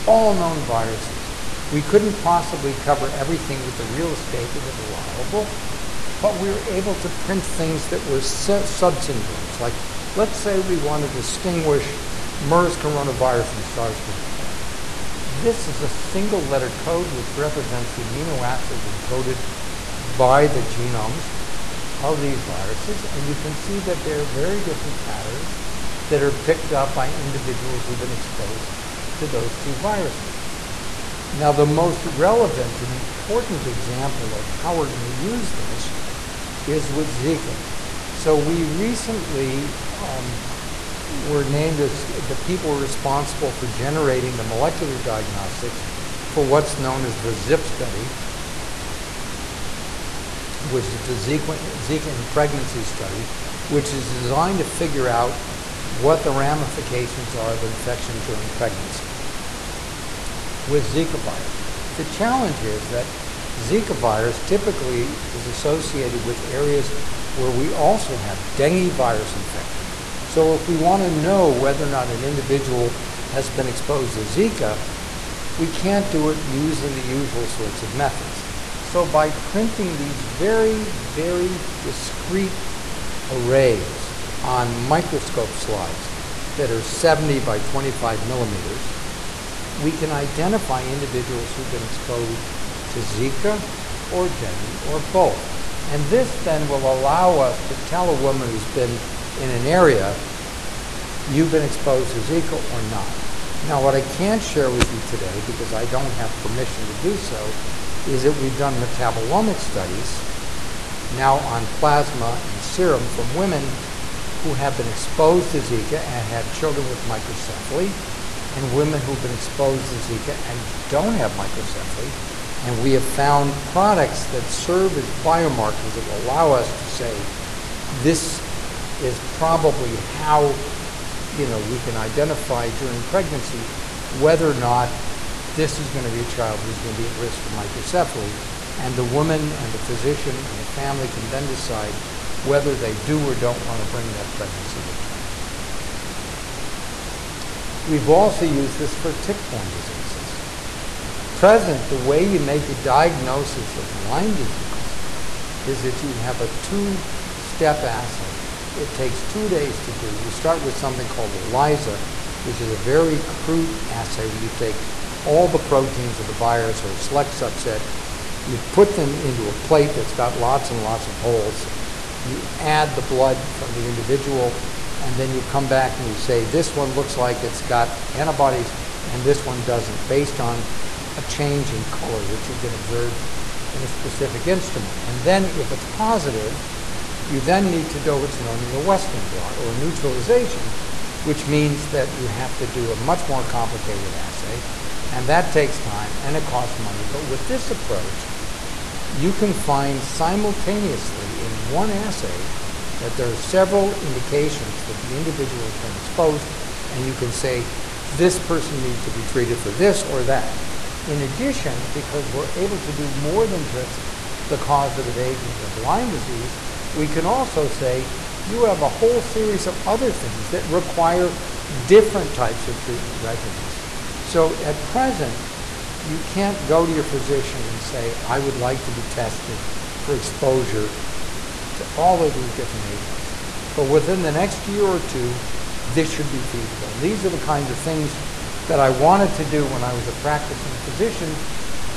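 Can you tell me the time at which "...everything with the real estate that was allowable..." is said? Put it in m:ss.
0:03.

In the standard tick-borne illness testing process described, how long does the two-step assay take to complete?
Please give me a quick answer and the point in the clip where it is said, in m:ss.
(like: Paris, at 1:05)
two days, at 2:39.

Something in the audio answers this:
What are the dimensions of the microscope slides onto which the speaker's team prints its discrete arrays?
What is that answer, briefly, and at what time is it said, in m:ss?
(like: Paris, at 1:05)
70 by 25 millimeters, at 1:26.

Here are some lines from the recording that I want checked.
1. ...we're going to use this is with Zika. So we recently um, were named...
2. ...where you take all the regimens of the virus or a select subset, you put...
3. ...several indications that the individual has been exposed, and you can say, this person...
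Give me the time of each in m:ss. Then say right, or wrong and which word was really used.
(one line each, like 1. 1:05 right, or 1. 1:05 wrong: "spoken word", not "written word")
1. 0:34 right
2. 2:44 wrong: "proteins", not "regimens"
3. 3:23 right.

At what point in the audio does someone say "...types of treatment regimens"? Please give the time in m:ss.
3:42.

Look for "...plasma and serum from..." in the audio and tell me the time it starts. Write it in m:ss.
1:51.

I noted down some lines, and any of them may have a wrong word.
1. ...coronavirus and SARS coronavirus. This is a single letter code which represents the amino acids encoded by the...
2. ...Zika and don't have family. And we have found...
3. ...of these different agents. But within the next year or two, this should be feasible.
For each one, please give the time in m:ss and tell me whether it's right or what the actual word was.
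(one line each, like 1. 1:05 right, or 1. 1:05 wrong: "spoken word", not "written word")
1. 0:12 right
2. 1:59 wrong: "microcephaly", not "family"
3. 3:52 right.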